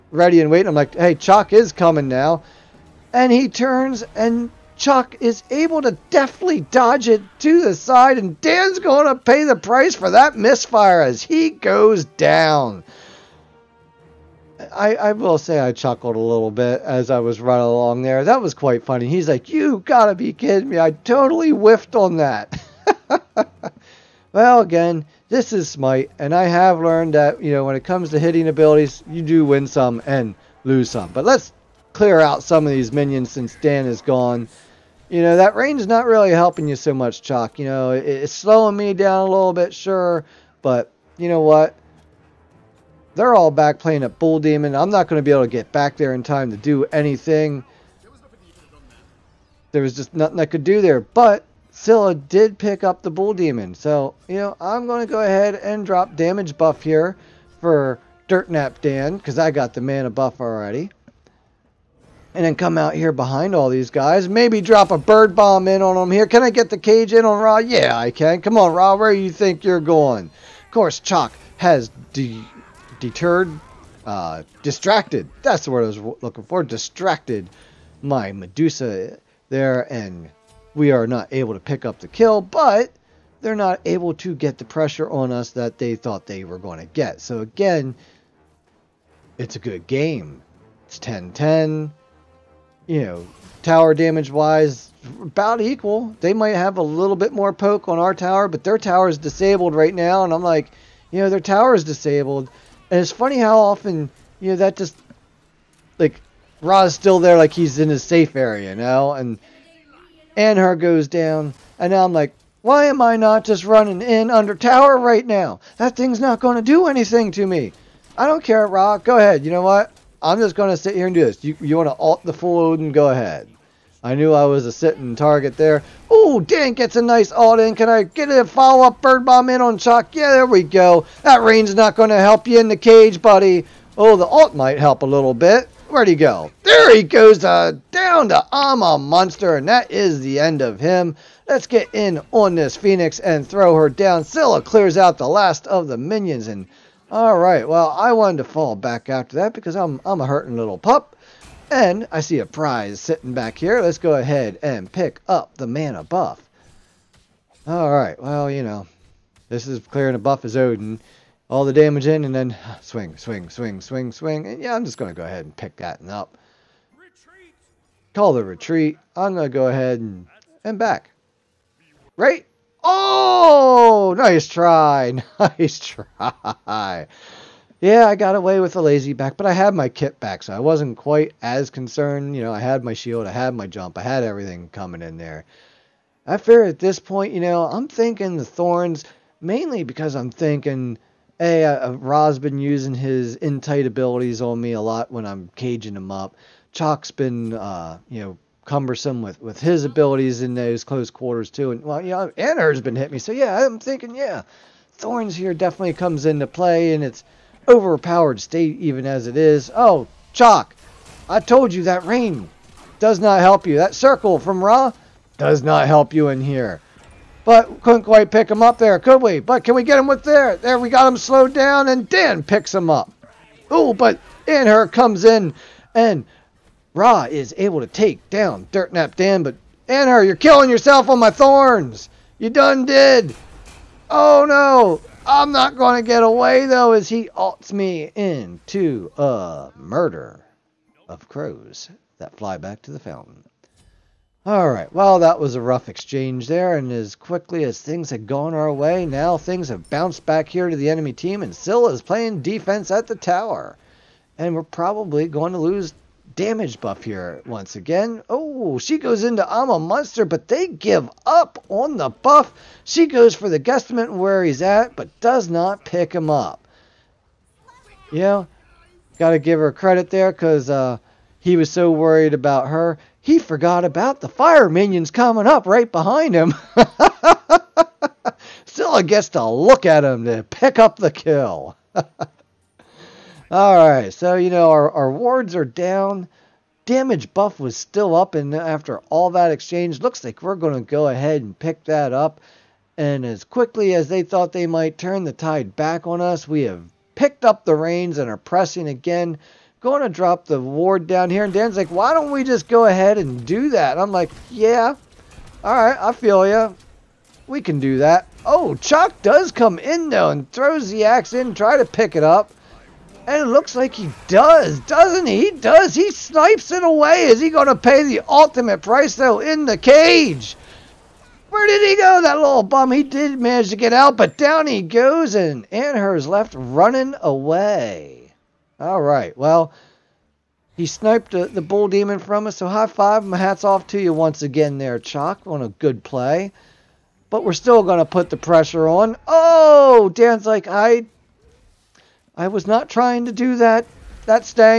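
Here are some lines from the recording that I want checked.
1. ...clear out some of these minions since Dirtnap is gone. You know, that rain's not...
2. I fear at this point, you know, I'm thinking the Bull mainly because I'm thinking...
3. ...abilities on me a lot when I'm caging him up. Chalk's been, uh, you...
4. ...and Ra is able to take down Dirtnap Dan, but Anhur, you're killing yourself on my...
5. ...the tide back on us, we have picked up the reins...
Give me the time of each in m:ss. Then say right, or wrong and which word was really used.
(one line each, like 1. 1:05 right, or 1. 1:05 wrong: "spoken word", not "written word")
1. 0:31 wrong: "Dan", not "Dirtnap"
2. 3:06 wrong: "Thorns", not "Bull"
3. 3:13 right
4. 3:45 right
5. 4:55 right.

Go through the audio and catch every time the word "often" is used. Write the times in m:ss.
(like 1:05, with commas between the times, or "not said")
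1:43.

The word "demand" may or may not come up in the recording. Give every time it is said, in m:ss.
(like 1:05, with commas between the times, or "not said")
not said.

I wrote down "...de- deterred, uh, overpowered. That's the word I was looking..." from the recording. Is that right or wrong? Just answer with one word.
wrong.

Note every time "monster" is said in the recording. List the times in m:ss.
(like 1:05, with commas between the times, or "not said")
2:18, 4:19.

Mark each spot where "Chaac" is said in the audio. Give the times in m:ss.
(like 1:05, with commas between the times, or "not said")
0:37, 1:11, 3:30, 5:35.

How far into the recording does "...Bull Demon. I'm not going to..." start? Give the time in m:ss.
0:44.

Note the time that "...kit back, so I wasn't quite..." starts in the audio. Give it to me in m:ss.
2:59.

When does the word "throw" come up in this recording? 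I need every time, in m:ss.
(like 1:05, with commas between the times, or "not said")
2:23, 5:10.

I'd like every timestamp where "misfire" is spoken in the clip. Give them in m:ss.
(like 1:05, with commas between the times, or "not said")
0:10.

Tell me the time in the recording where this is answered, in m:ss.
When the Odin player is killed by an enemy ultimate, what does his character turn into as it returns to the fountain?
3:59.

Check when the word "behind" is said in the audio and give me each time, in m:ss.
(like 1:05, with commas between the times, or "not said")
1:03, 4:35.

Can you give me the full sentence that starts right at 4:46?
Damage buff was still up, and after all that exchange, looks like we're going to go ahead and pick that up.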